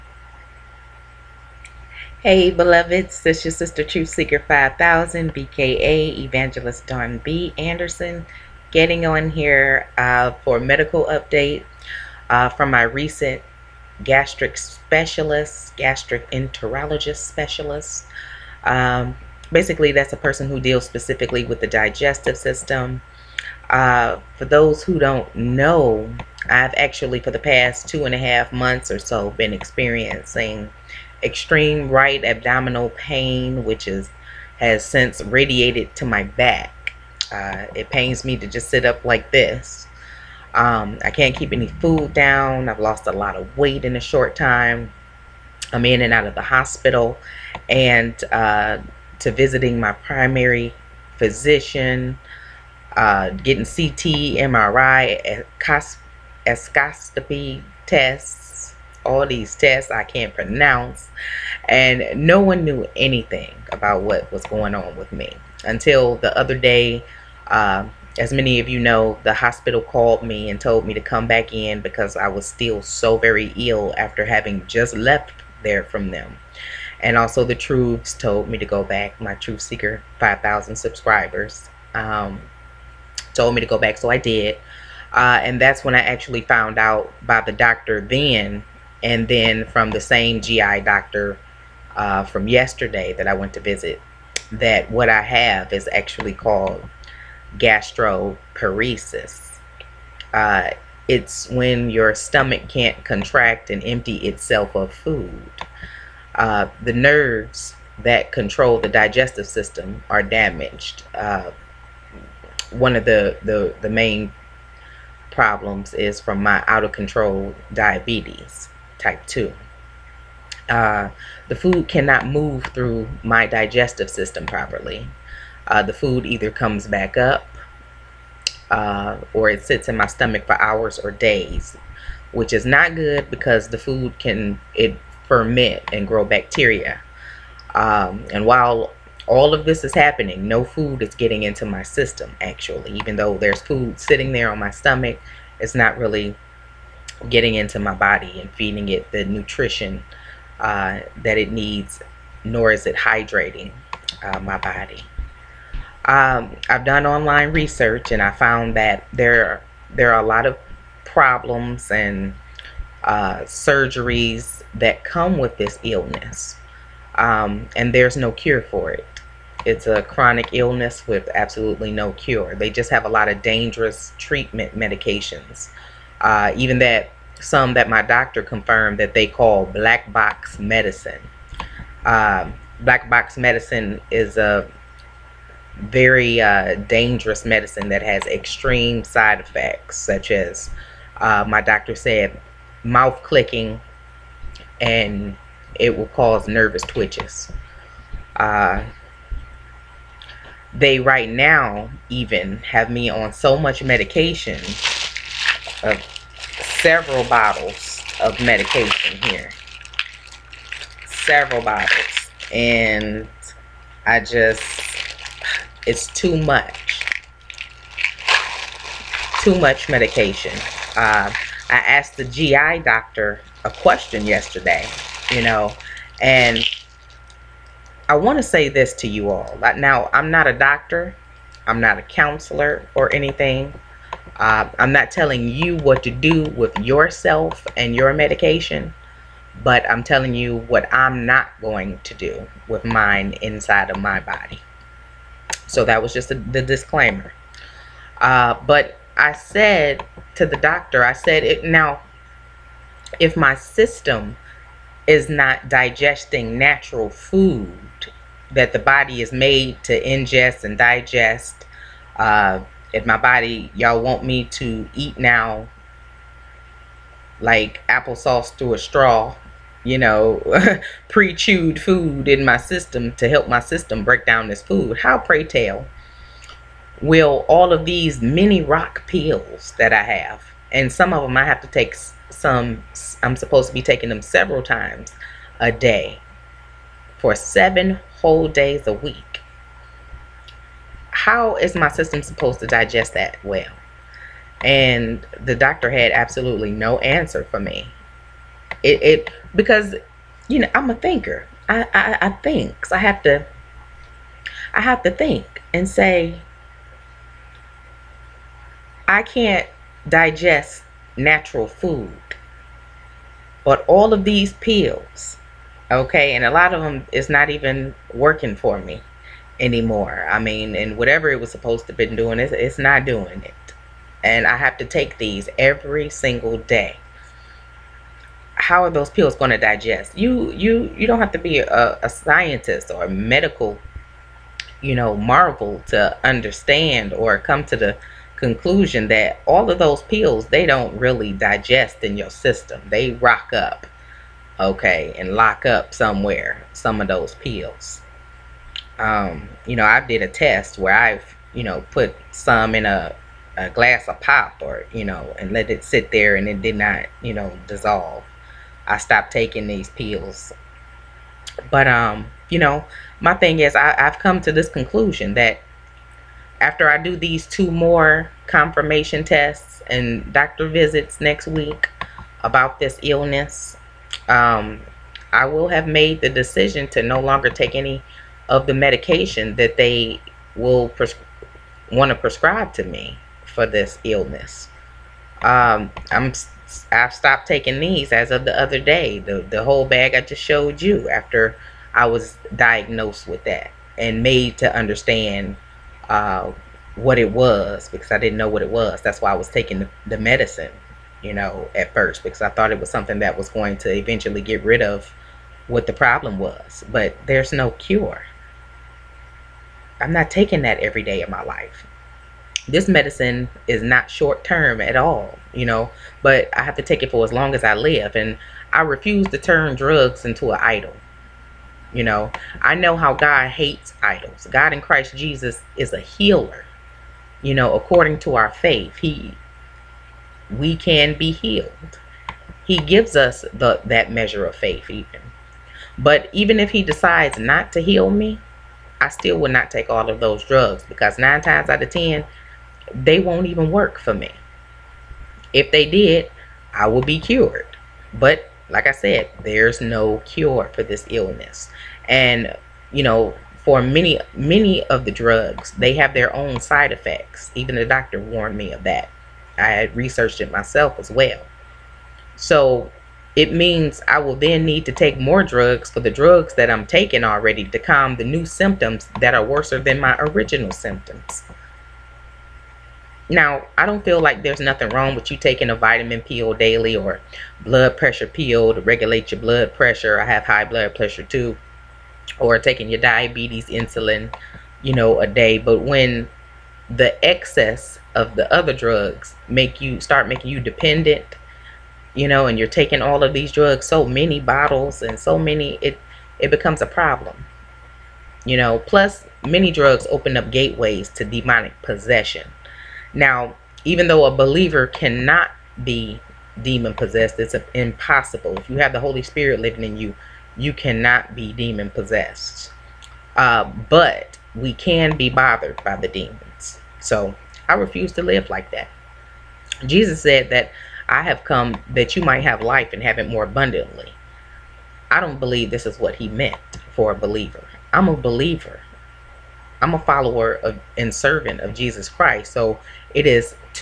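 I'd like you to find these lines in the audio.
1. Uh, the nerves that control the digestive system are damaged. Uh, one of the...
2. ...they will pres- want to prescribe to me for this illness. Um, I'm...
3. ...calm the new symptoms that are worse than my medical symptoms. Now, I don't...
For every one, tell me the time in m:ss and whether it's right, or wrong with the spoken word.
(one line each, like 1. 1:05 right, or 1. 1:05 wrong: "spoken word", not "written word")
1. 1:46 right
2. 6:19 right
3. 7:47 wrong: "original", not "medical".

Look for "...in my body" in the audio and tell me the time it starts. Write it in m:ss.
4:22.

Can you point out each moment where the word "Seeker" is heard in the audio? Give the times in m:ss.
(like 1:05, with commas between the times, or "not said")
0:04, 1:19.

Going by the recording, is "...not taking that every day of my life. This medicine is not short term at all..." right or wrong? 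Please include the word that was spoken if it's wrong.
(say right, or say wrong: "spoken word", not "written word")
right.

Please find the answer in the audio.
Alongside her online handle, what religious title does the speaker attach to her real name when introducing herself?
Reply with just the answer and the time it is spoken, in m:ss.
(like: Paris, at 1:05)
Evangelist, at 0:06.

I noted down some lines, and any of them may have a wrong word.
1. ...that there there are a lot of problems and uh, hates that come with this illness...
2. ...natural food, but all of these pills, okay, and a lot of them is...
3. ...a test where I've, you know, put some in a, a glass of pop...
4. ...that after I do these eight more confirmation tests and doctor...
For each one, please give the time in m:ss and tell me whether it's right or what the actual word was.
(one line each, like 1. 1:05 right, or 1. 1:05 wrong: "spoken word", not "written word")
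1. 2:38 wrong: "surgeries", not "hates"
2. 5:11 right
3. 5:50 right
4. 6:05 wrong: "two", not "eight".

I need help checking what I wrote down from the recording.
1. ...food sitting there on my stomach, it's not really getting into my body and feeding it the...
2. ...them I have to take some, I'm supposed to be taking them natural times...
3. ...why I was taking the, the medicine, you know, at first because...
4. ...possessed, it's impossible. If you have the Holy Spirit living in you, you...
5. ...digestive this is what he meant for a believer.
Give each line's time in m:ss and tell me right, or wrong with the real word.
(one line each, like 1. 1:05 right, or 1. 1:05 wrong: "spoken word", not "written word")
1. 2:23 right
2. 4:41 wrong: "several", not "natural"
3. 6:39 right
4. 8:26 right
5. 8:45 wrong: "believe", not "digestive".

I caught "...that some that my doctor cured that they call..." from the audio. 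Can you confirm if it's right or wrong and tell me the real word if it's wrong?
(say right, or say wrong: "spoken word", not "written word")
wrong: "confirmed", not "cured".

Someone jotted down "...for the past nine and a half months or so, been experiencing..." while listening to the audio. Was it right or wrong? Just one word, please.
wrong.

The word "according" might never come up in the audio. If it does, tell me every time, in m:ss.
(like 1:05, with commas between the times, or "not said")
7:07.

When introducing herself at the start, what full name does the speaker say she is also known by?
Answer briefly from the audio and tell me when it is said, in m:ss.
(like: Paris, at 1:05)
Dawn B. Anderson, at 0:06.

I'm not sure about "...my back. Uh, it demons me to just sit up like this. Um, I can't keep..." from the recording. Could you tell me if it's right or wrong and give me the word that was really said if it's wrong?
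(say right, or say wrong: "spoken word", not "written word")
wrong: "pains", not "demons".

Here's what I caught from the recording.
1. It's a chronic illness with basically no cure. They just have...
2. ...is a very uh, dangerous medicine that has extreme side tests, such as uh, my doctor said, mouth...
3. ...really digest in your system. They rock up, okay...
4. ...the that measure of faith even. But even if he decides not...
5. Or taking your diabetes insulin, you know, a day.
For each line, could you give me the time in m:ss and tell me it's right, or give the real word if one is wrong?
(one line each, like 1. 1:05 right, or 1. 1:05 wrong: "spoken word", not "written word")
1. 2:49 wrong: "absolutely", not "basically"
2. 3:04 wrong: "effects", not "tests"
3. 5:40 right
4. 7:13 right
5. 8:02 right.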